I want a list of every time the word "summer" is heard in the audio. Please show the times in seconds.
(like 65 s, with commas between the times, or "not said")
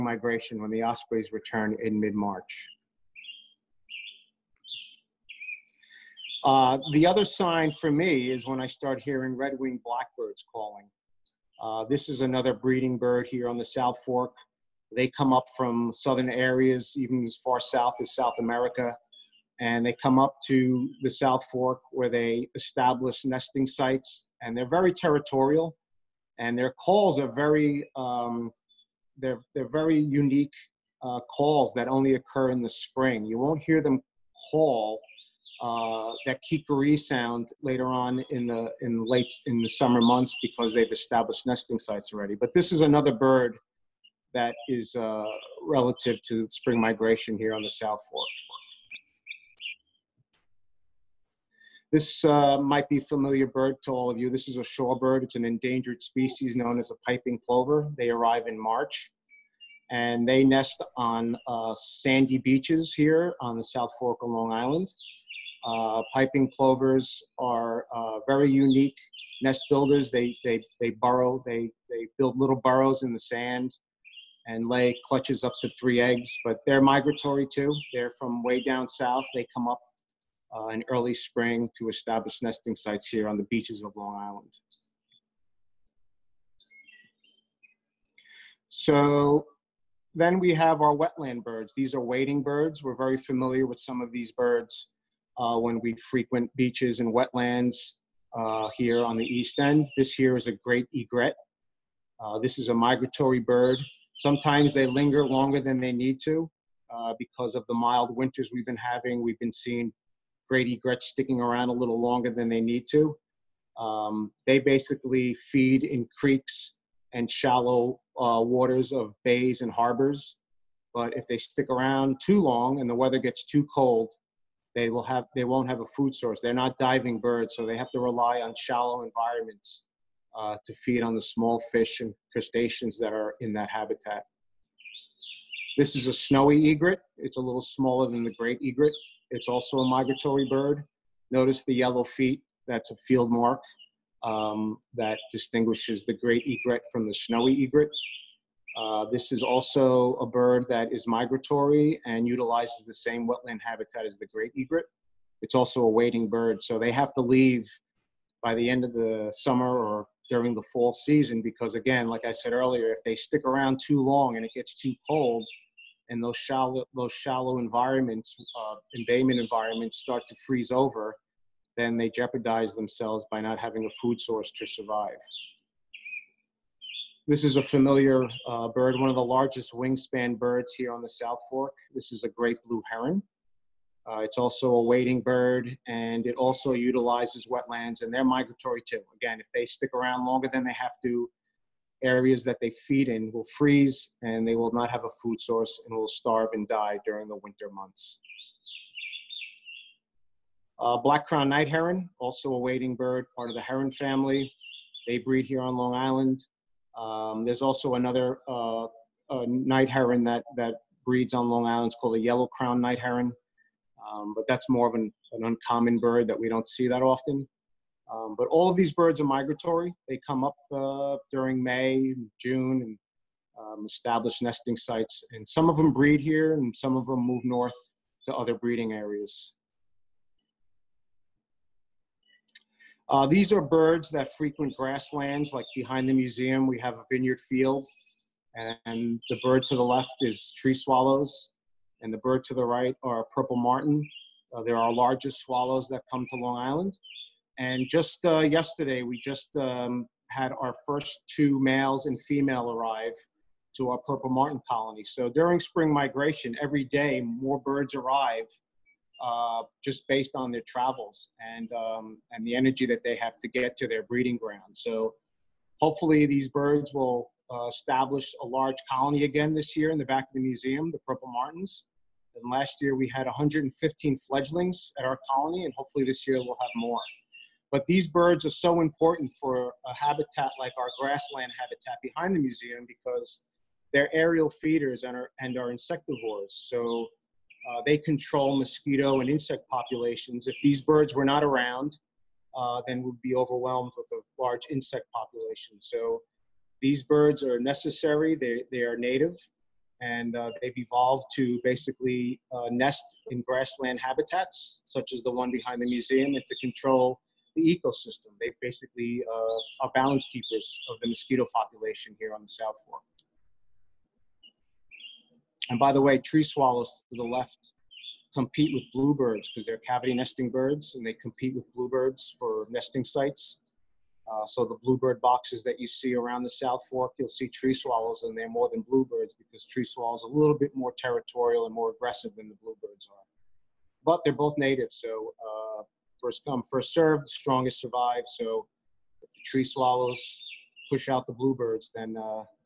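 39 s, 159 s.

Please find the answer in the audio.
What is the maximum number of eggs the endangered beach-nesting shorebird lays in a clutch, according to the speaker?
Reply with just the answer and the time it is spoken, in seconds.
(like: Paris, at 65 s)
3, at 75 s.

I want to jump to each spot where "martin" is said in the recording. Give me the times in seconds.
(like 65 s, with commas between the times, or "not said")
243 s, 254 s, 271 s.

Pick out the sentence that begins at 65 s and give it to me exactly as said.
Uh, piping plovers are uh, very unique nest builders.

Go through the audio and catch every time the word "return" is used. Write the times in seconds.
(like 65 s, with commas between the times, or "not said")
1 s.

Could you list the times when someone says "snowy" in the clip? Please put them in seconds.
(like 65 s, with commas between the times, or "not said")
136 s, 147 s.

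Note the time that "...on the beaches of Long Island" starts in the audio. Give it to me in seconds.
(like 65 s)
83 s.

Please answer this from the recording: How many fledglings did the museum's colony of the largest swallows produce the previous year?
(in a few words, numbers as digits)
115.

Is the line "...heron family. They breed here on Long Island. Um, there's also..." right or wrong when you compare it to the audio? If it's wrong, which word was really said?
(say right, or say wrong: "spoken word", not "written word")
right.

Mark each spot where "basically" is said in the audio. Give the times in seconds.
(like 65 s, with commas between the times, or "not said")
114 s, 301 s, 308 s.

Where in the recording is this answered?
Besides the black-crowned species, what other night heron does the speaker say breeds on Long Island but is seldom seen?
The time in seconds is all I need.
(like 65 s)
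212 s.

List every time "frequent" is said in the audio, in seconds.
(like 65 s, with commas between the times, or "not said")
96 s, 234 s.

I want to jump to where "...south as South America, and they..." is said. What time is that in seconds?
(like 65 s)
17 s.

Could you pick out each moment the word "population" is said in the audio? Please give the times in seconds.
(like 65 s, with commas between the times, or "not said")
289 s, 295 s, 311 s.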